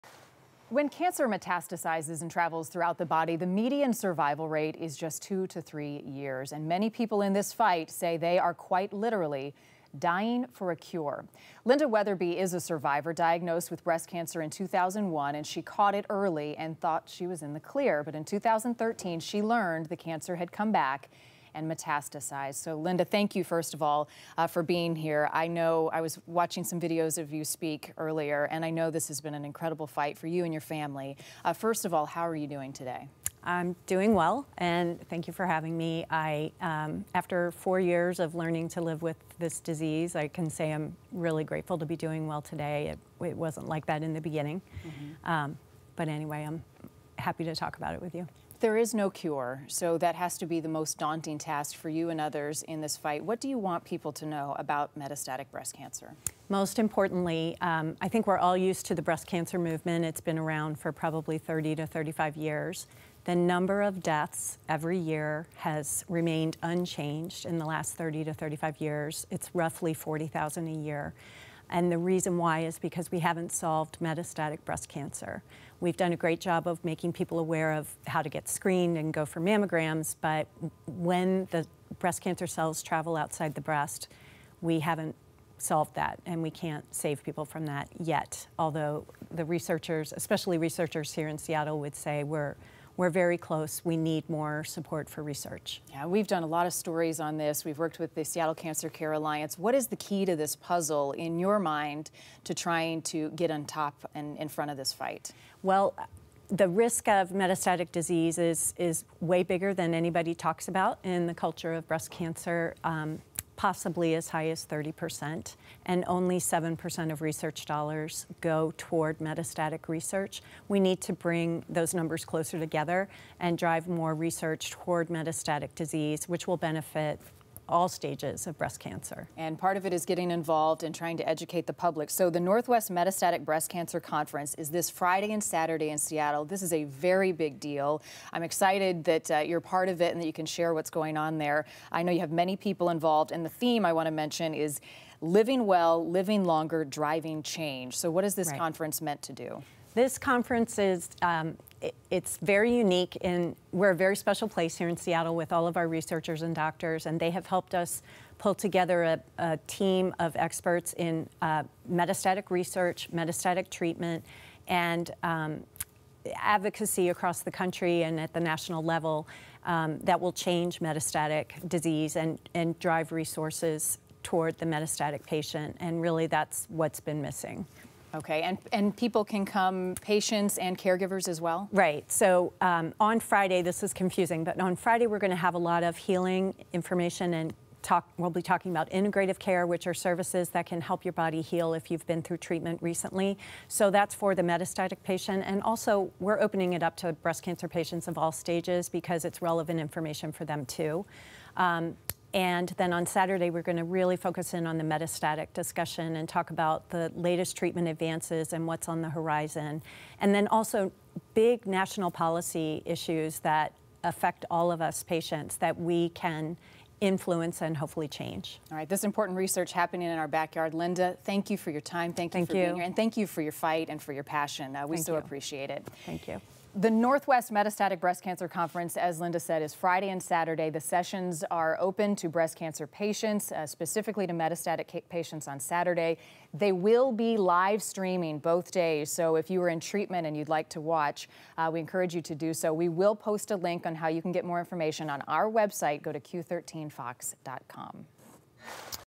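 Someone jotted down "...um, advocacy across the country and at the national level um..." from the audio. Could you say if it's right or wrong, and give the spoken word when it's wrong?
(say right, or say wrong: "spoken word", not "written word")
right.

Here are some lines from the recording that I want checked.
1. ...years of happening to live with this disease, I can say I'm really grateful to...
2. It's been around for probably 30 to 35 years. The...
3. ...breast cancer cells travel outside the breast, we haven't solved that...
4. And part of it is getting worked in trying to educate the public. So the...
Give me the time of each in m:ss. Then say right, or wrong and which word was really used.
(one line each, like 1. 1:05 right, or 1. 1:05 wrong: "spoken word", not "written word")
1. 0:37 wrong: "learning", not "happening"
2. 1:00 right
3. 1:21 right
4. 2:09 wrong: "involved", not "worked".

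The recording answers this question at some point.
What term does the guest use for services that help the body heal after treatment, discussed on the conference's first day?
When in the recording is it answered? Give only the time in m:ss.
3:08.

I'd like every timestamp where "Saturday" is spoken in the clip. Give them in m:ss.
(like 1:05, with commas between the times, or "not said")
2:15, 3:23, 3:50, 3:55.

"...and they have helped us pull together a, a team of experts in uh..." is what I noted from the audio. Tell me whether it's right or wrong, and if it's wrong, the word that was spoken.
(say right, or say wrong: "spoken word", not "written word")
right.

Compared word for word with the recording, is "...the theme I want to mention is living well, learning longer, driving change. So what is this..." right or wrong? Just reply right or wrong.
wrong.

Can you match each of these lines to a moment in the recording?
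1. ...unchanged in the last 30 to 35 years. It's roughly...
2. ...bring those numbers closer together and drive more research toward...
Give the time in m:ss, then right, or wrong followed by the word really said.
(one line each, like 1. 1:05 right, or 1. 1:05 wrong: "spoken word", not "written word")
1. 1:06 right
2. 2:01 right.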